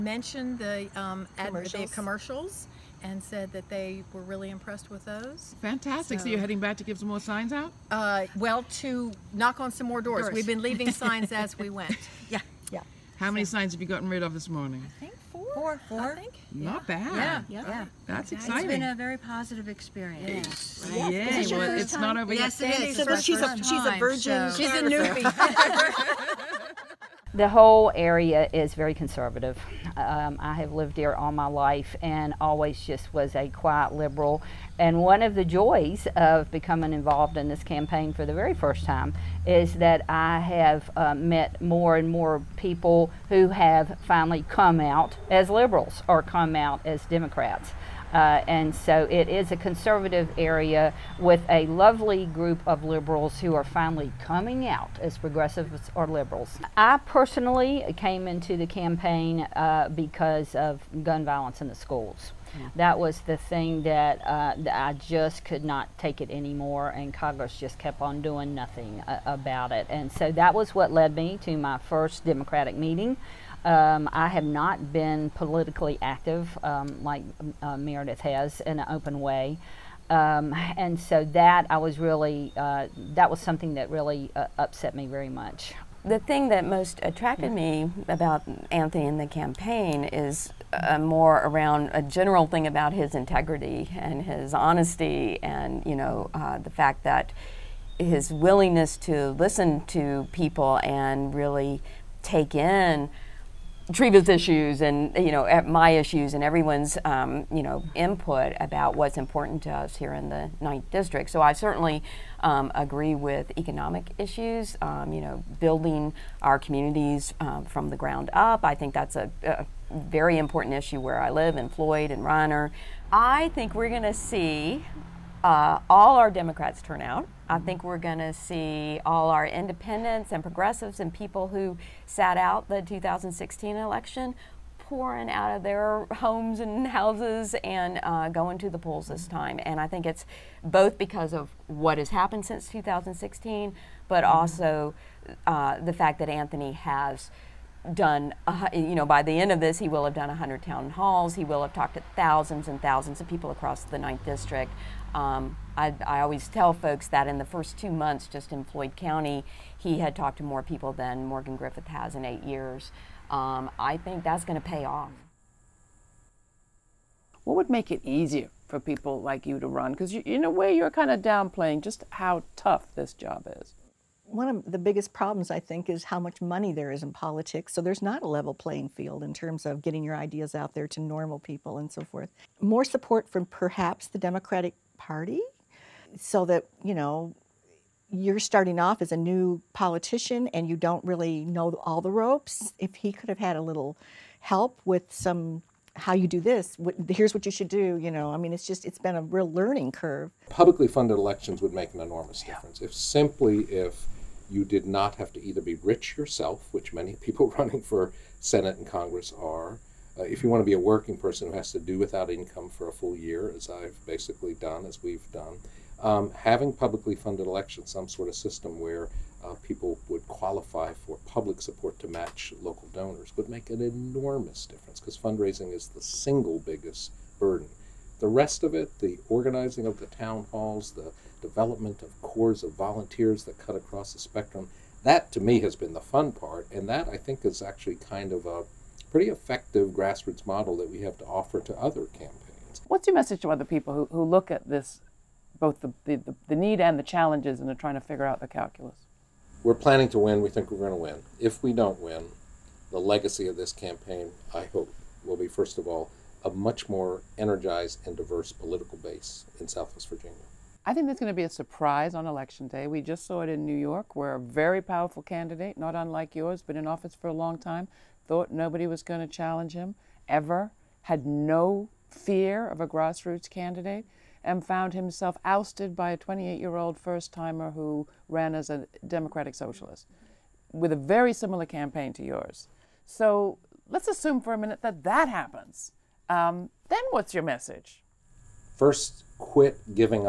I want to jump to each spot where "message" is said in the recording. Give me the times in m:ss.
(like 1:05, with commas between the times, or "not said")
4:03, 4:47.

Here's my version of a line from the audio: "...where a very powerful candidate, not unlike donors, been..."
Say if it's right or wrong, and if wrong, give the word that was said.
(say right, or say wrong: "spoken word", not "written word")
wrong: "yours", not "donors".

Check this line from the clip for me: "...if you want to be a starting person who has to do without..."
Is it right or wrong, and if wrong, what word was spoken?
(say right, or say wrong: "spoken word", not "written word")
wrong: "working", not "starting".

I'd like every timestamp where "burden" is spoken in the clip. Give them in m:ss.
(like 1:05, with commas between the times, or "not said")
3:47.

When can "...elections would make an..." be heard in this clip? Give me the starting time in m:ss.
3:21.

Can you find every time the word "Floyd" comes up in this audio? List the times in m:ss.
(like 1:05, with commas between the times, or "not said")
2:01, 2:38.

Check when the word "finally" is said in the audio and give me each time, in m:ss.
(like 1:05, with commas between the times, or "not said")
0:44, 0:53.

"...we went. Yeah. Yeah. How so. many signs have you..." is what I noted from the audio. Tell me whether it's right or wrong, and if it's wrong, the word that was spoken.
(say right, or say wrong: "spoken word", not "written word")
right.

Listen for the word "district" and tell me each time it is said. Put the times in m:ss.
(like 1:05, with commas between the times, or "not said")
1:50, 2:34.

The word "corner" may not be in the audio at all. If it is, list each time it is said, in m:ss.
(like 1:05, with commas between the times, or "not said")
not said.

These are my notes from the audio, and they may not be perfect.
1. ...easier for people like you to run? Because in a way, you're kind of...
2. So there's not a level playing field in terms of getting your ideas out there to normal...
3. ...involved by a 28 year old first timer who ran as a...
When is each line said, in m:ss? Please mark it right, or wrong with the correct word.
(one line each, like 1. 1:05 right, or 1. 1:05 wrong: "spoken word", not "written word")
1. 2:48 right
2. 2:57 right
3. 4:35 wrong: "ousted", not "involved".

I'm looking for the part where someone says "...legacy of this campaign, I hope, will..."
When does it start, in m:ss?
4:12.